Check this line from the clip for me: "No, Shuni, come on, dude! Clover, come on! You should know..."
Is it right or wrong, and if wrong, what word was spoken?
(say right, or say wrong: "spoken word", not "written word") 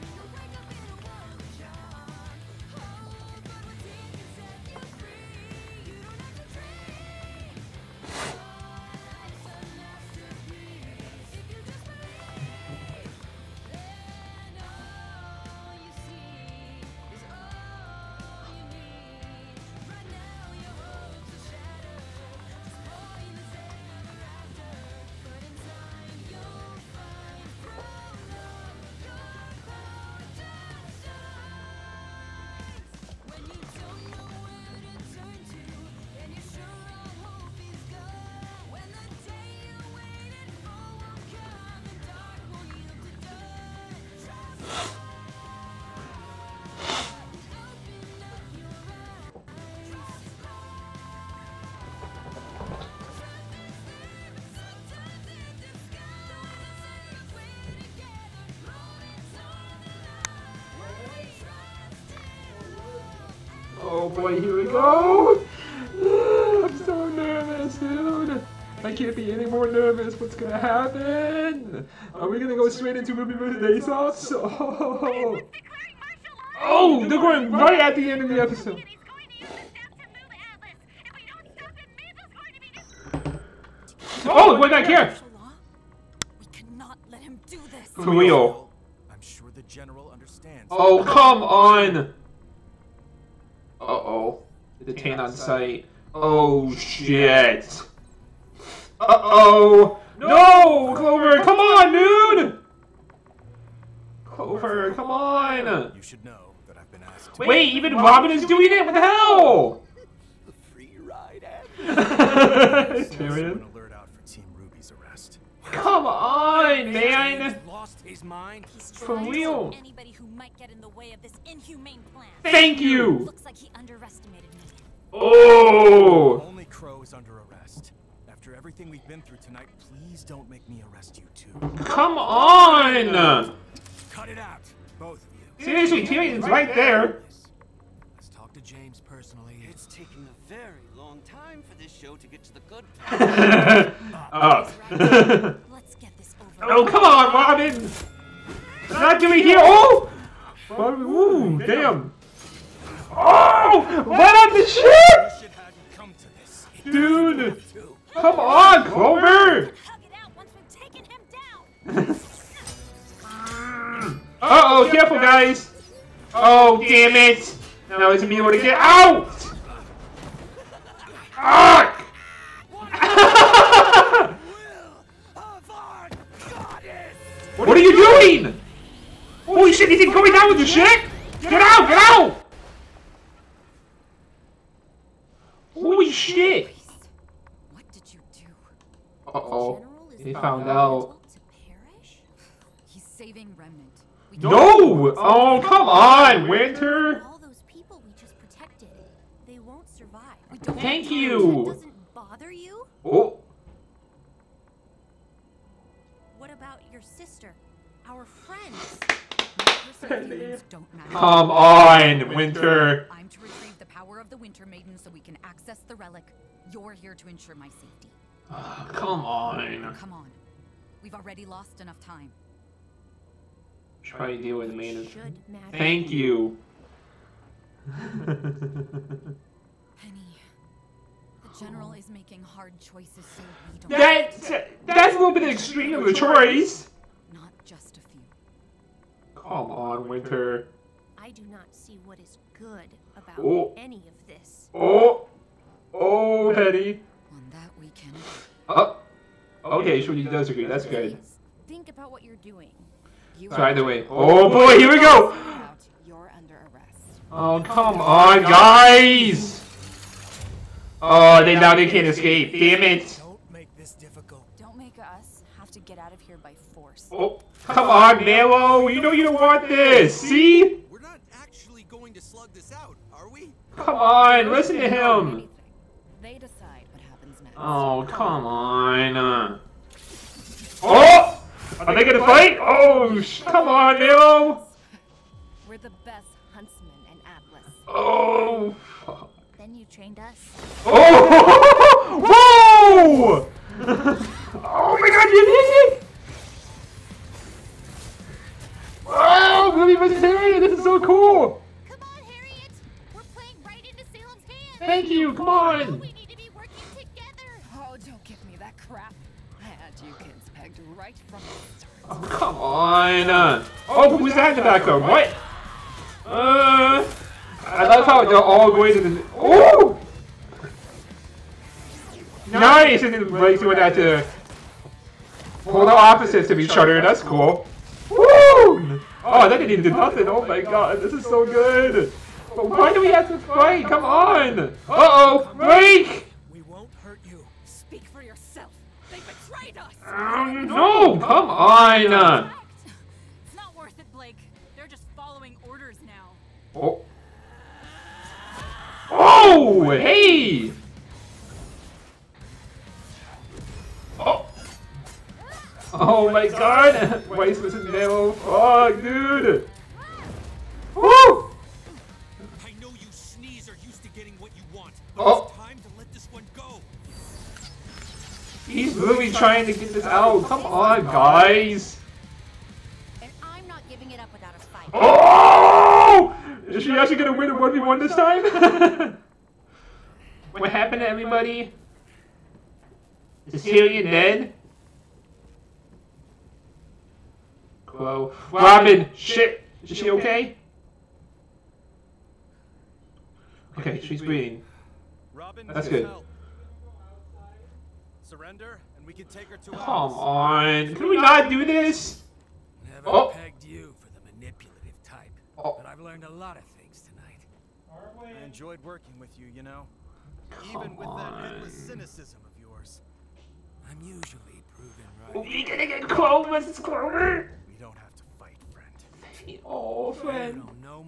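wrong: "Clover", not "Shuni".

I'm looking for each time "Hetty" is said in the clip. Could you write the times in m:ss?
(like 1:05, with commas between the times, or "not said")
4:06.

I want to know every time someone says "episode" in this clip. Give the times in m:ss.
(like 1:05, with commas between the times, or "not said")
1:18.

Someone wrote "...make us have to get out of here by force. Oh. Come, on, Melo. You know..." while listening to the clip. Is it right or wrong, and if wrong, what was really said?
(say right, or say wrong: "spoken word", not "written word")
right.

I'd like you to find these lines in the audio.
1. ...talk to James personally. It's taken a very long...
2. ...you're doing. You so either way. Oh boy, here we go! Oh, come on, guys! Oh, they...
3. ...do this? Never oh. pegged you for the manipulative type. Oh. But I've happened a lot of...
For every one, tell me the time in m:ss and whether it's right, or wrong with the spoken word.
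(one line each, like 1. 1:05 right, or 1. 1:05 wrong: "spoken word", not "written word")
1. 2:18 right
2. 4:12 right
3. 6:41 wrong: "learned", not "happened".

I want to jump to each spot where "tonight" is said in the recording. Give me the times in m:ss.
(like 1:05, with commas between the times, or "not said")
2:09, 6:47.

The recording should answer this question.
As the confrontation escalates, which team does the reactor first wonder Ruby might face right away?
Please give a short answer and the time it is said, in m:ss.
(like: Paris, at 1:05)
Ace Ops, at 1:13.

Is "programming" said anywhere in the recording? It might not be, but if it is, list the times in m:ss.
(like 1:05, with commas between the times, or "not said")
not said.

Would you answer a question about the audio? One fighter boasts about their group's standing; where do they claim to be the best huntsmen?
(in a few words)
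Atlas.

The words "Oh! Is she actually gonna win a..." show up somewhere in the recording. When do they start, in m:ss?
6:14.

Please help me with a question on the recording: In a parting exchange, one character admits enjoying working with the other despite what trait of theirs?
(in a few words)
endless cynicism.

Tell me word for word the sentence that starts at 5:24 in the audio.
Uh, polar opposites of each other.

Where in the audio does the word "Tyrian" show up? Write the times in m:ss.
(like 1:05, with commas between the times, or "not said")
1:53, 2:16.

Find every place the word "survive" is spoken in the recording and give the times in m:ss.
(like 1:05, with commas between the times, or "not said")
3:19.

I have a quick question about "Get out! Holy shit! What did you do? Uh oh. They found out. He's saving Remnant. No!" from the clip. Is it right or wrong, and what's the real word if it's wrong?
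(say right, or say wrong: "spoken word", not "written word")
right.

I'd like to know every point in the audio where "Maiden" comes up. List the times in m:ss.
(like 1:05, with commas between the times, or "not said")
3:34, 3:44.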